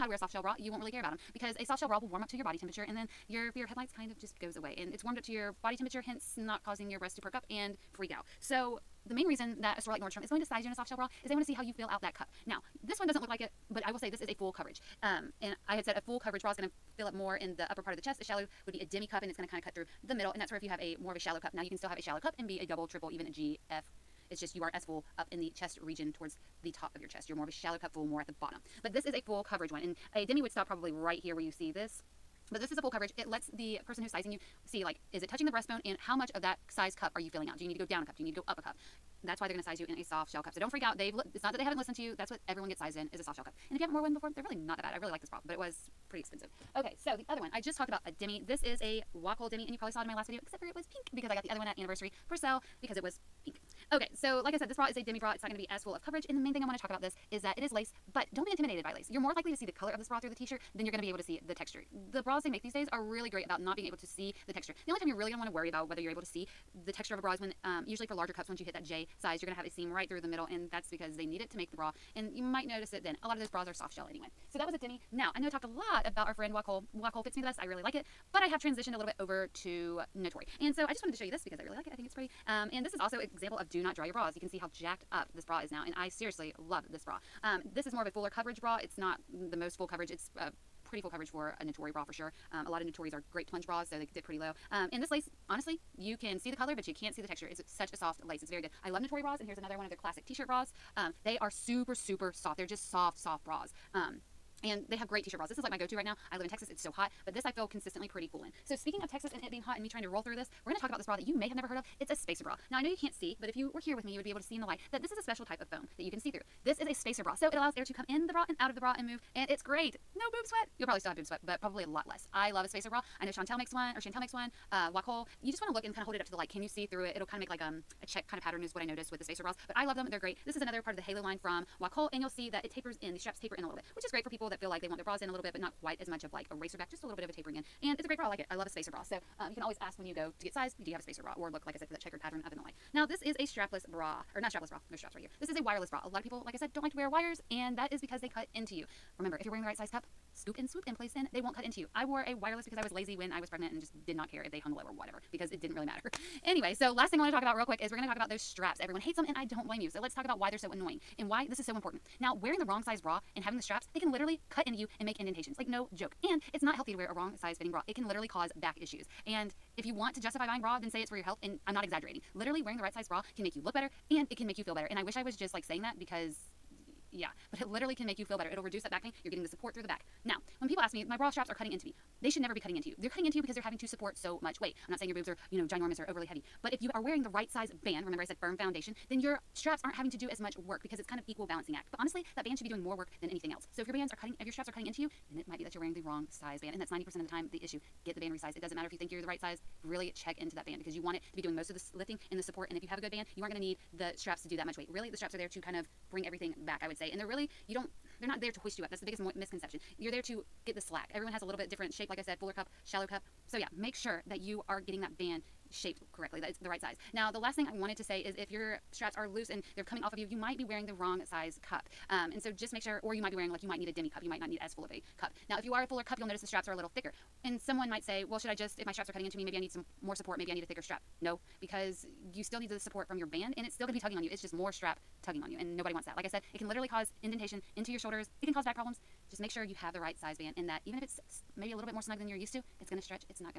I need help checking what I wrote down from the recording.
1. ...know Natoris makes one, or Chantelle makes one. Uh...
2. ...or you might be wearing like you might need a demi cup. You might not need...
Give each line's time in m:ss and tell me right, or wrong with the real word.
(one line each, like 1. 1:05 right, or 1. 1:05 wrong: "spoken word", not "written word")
1. 2:03 wrong: "Chantelle", not "Natoris"
2. 3:43 right.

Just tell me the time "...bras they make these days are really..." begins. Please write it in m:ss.
1:02.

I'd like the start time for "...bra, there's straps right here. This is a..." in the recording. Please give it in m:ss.
2:24.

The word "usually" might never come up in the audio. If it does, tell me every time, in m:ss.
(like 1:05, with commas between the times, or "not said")
1:07.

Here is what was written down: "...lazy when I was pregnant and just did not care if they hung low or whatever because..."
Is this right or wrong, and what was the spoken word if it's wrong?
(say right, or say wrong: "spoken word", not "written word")
right.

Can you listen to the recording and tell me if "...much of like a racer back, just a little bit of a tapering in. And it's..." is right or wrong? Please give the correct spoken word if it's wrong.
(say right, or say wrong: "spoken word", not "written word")
right.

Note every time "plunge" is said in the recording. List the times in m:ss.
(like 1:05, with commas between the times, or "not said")
1:33.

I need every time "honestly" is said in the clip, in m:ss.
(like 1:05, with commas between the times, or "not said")
1:35, 3:11.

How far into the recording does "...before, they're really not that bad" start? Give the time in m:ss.
0:44.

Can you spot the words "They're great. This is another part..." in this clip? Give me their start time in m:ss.
2:10.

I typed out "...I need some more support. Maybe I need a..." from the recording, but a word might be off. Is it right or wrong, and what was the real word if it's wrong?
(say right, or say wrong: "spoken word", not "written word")
right.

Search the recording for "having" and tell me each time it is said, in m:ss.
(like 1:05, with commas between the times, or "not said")
2:43, 3:03, 3:09.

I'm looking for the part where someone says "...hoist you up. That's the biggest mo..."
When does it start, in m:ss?
3:28.